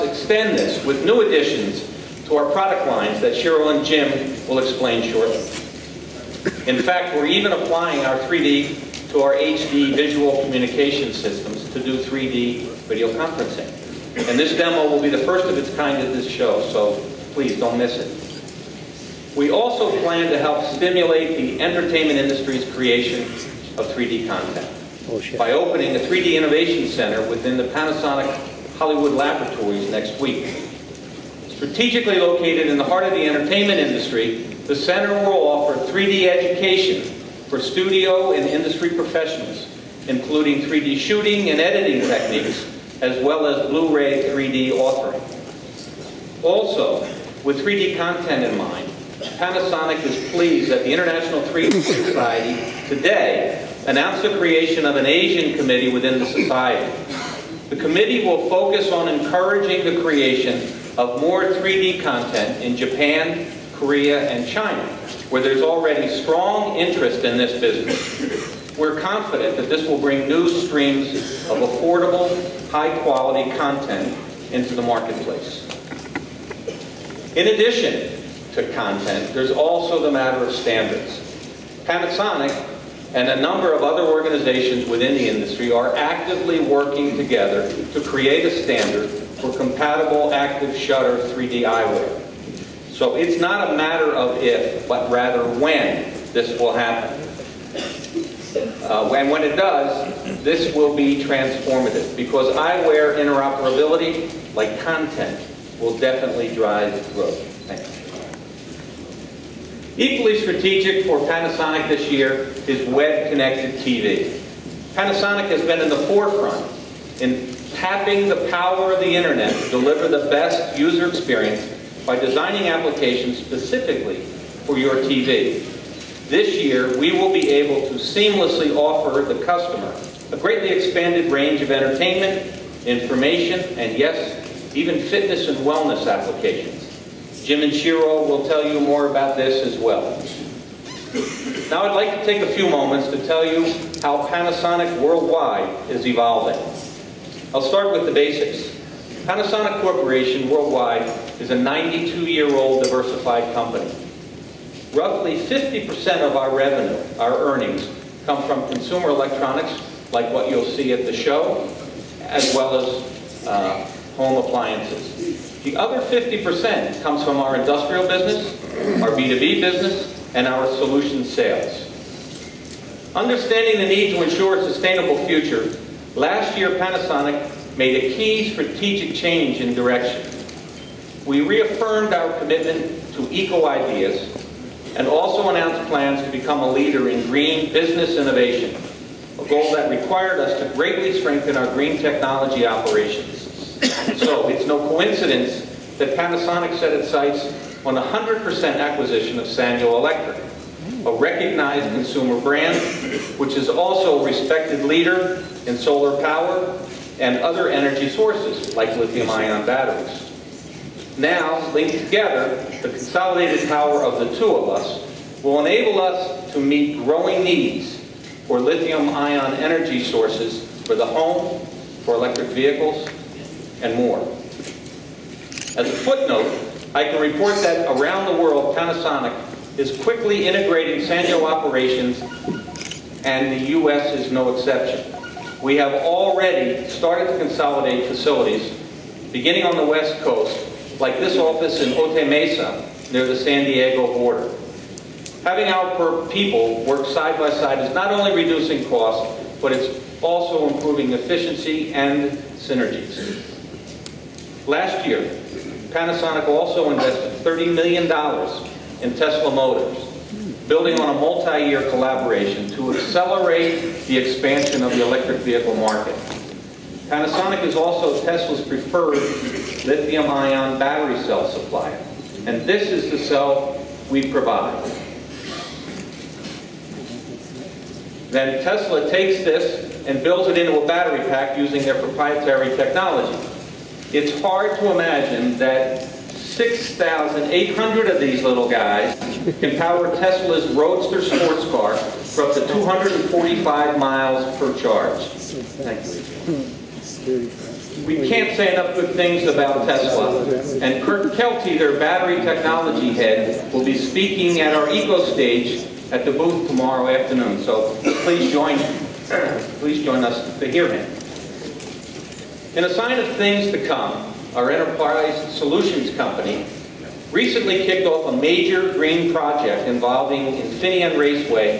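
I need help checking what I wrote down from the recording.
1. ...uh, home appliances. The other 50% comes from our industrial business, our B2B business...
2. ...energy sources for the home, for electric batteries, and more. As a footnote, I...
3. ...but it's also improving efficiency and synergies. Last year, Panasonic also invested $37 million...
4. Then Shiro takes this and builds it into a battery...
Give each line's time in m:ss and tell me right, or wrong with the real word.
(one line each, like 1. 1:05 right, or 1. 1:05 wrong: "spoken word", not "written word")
1. 2:43 right
2. 3:39 wrong: "vehicles", not "batteries"
3. 4:09 wrong: "30", not "37"
4. 4:38 wrong: "Tesla", not "Shiro".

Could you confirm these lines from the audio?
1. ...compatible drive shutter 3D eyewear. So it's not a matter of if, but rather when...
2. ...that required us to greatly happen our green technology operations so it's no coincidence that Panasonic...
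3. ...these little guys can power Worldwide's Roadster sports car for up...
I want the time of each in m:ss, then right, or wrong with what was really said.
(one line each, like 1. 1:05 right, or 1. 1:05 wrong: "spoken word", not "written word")
1. 1:29 wrong: "active", not "drive"
2. 3:09 wrong: "strengthen", not "happen"
3. 4:48 wrong: "Tesla", not "Worldwide".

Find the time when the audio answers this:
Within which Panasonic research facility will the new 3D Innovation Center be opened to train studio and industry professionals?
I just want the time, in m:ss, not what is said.
0:27.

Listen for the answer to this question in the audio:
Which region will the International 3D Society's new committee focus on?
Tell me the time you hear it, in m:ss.
0:55.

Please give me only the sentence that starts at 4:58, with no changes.
We can't say enough good things about Tesla.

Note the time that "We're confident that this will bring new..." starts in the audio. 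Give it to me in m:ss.
1:08.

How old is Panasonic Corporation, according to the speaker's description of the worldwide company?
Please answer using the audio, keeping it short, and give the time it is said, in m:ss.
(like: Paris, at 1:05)
92 years, at 2:31.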